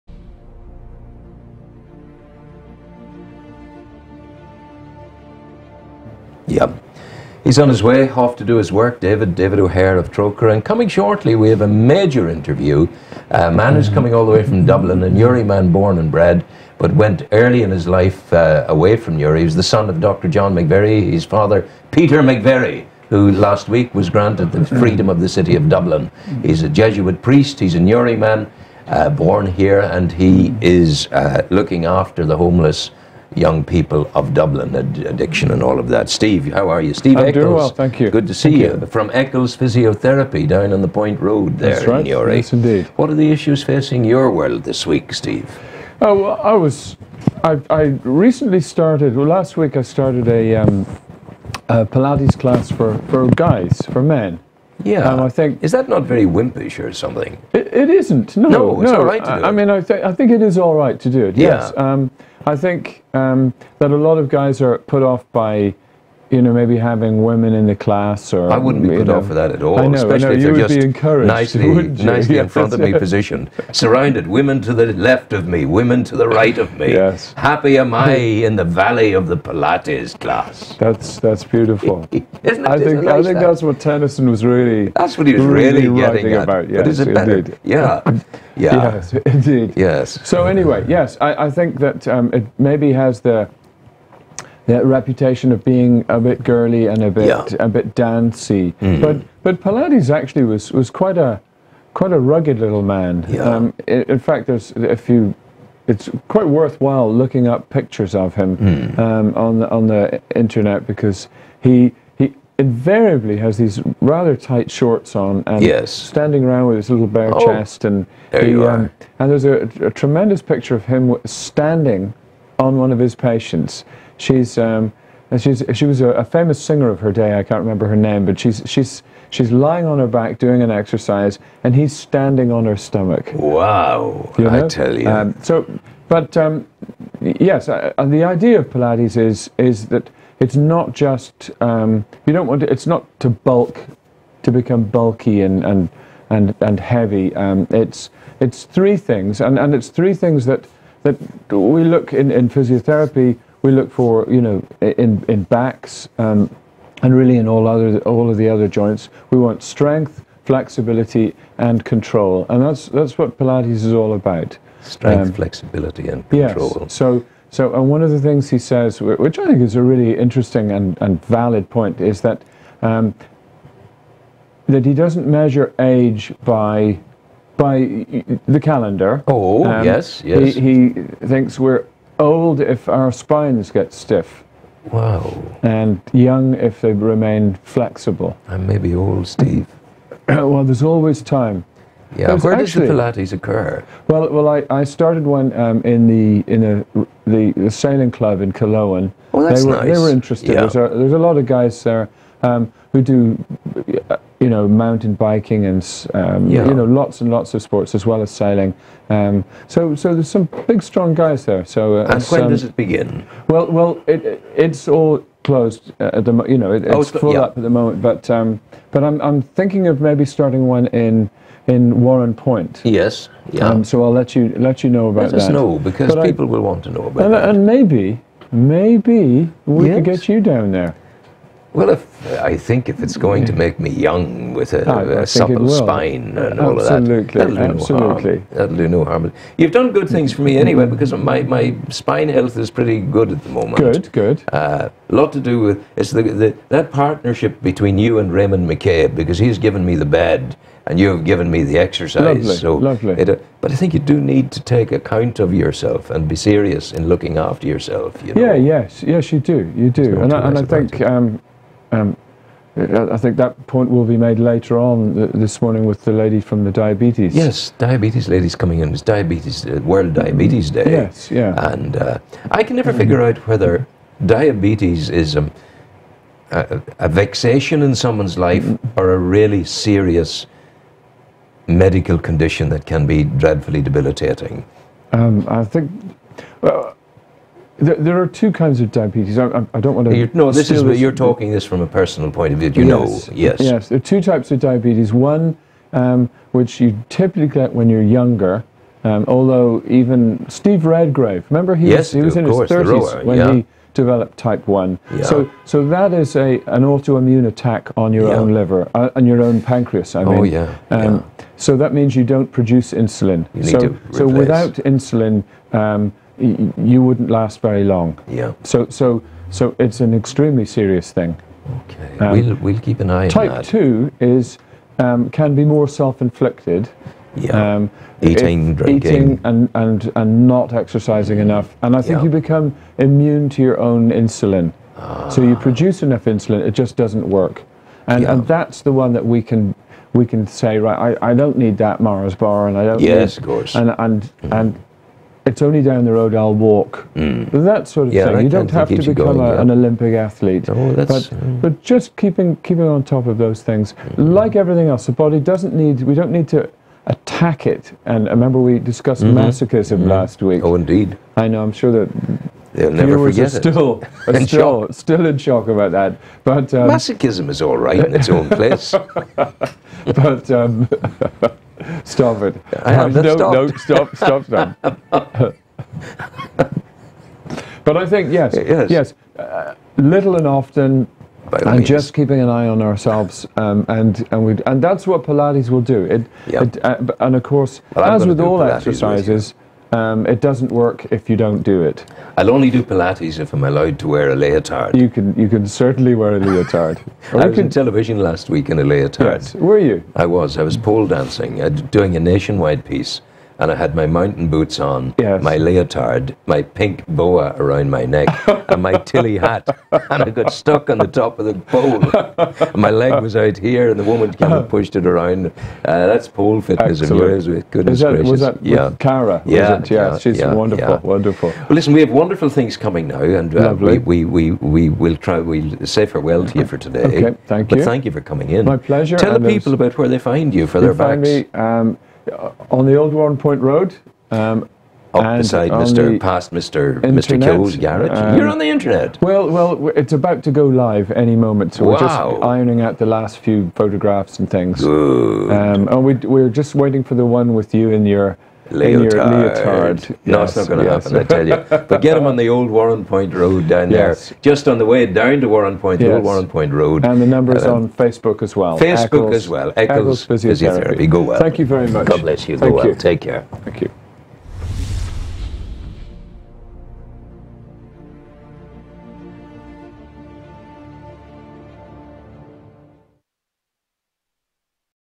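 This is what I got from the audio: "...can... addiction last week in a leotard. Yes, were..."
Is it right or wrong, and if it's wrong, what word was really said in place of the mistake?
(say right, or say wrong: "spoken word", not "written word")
wrong: "television", not "addiction".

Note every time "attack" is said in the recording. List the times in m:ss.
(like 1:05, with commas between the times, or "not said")
5:07, 5:57.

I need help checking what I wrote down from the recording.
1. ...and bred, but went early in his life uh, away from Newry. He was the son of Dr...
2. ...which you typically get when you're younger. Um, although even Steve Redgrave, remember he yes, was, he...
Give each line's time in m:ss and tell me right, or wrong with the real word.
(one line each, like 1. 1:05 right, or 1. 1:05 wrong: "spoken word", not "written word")
1. 0:15 right
2. 4:56 right.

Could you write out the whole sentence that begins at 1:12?
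in front of me positioned, surrounded.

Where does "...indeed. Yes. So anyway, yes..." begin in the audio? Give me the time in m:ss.
1:29.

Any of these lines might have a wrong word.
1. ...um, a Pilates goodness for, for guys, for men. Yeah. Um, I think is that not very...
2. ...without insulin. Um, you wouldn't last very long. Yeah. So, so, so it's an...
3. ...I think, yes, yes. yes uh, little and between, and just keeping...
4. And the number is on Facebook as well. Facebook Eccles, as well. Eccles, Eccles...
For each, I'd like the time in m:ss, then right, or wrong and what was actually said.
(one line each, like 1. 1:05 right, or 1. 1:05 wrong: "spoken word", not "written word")
1. 0:50 wrong: "class", not "goodness"
2. 5:14 right
3. 6:17 wrong: "often", not "between"
4. 7:37 right.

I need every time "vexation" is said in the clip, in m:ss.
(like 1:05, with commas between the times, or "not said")
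4:37.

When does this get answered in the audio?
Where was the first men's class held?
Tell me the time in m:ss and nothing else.
3:17.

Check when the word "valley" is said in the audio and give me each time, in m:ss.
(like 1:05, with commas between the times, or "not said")
1:18.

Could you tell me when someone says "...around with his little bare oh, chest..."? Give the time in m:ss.
1:56.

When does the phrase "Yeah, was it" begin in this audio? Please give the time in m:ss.
6:59.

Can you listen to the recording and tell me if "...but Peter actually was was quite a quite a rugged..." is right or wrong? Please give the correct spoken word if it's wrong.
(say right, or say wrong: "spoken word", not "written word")
wrong: "Pilates", not "Peter".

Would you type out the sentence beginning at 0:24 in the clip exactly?
freedom of the city of Dublin.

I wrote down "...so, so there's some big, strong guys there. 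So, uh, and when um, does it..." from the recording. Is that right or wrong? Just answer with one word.
right.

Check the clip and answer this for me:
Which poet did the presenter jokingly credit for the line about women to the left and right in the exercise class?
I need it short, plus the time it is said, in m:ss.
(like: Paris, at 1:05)
Tennyson, at 1:23.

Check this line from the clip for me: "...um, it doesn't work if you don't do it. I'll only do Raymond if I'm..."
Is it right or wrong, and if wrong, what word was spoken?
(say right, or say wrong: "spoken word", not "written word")
wrong: "Pilates", not "Raymond".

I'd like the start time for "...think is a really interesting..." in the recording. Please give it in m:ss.
2:49.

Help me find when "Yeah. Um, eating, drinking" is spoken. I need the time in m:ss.
5:27.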